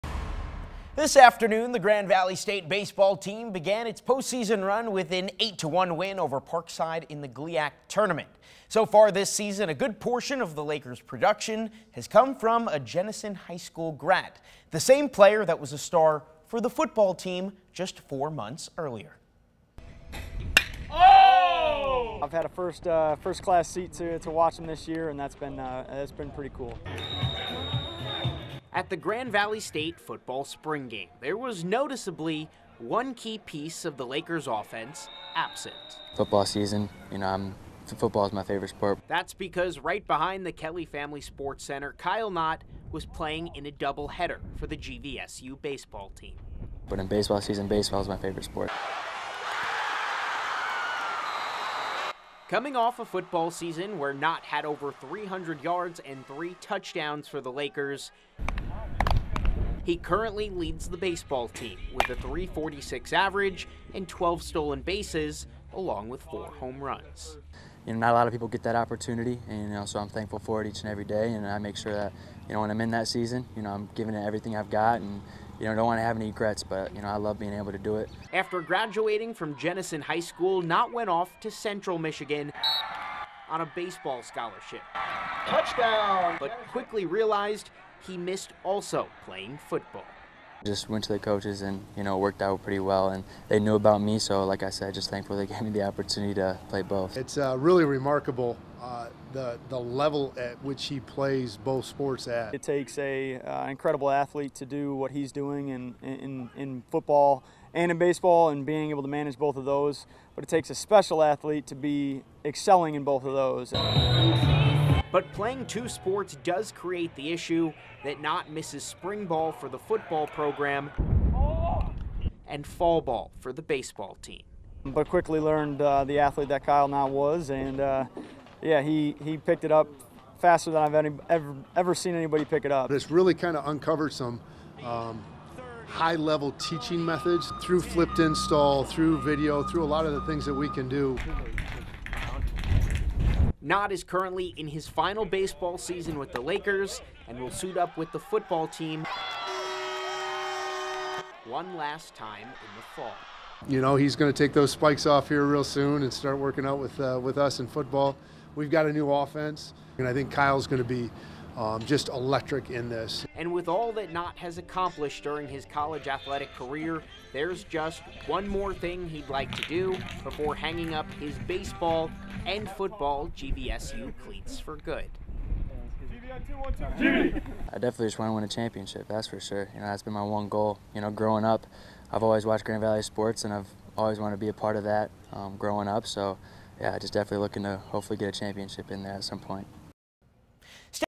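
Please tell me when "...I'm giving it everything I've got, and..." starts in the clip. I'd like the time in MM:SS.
01:13.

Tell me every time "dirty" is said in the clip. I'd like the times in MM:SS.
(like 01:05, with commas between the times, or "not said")
not said.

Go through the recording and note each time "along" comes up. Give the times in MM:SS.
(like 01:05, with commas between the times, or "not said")
01:05.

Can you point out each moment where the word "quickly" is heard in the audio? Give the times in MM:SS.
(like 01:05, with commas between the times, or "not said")
01:26, 02:05.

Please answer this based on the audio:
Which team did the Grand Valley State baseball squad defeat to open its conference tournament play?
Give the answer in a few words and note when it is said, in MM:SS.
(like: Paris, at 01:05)
Parkside, at 00:06.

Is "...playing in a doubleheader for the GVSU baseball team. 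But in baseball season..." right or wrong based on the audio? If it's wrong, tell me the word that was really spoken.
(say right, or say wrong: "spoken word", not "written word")
right.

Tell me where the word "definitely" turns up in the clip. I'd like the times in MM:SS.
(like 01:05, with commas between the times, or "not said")
02:57, 03:07.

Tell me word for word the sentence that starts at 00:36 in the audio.
Football season, you know, I'm football is my favorite sport.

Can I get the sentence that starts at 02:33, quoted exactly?
You know, he's going to take those spikes off here real soon and start working out with, uh, with us in football.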